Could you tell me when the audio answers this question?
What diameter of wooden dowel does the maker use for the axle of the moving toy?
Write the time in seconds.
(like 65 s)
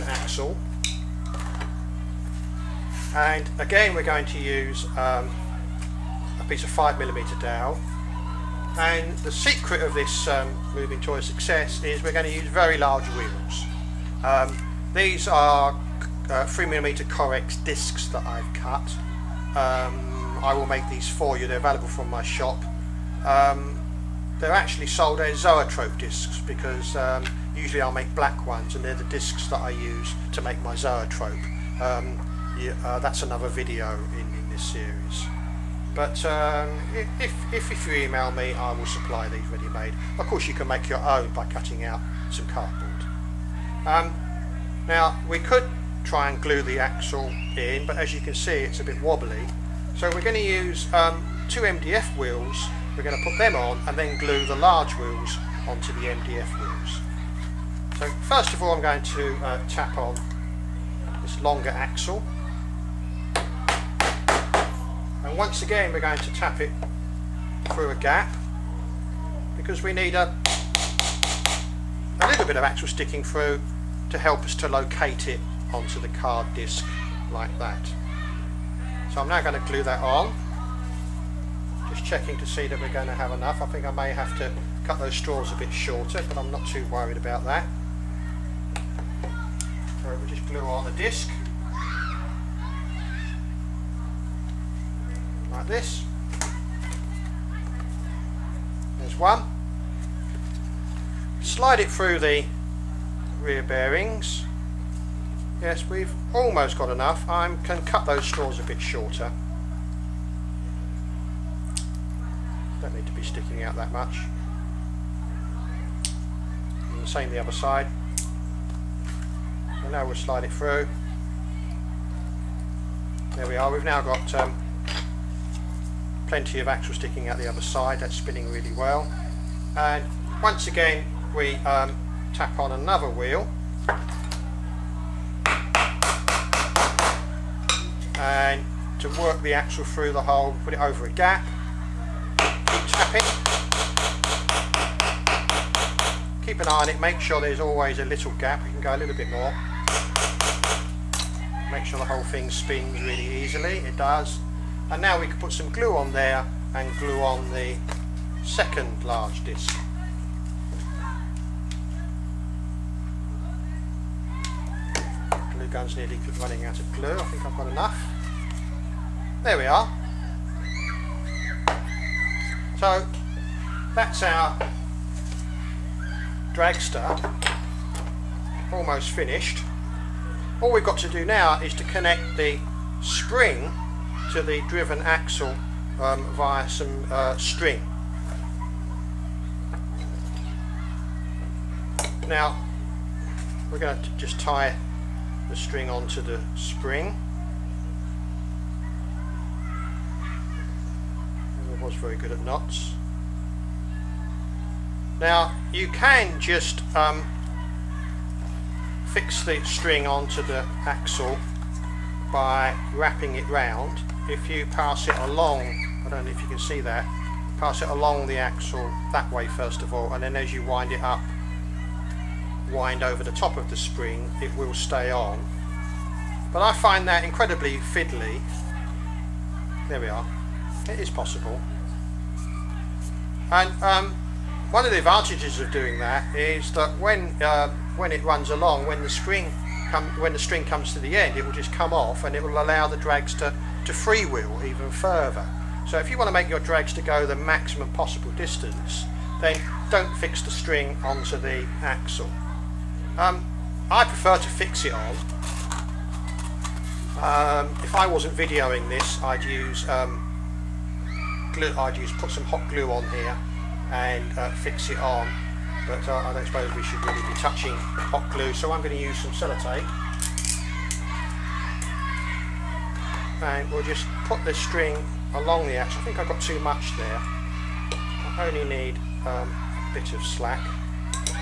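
6 s.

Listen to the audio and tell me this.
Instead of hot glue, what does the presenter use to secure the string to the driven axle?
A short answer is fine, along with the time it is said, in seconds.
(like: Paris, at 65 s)
Sellotape, at 269 s.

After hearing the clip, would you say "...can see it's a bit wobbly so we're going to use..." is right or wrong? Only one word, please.
right.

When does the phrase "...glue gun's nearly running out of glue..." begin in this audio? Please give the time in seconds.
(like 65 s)
165 s.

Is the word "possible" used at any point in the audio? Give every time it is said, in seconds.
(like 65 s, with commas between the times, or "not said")
231 s, 247 s.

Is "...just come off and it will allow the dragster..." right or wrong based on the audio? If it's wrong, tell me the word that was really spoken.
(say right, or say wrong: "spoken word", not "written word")
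right.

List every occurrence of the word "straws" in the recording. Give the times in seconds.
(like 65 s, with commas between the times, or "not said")
85 s, 108 s.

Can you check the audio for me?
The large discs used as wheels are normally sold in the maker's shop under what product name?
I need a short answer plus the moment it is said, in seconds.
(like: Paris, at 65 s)
Zoetrope discs, at 25 s.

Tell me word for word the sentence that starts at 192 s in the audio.
Now we're going to just tie the string onto the spring.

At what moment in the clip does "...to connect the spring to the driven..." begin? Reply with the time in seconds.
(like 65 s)
181 s.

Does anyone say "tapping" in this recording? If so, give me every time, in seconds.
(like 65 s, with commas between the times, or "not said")
142 s.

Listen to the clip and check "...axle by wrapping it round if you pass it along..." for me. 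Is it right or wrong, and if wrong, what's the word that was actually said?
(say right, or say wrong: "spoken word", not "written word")
right.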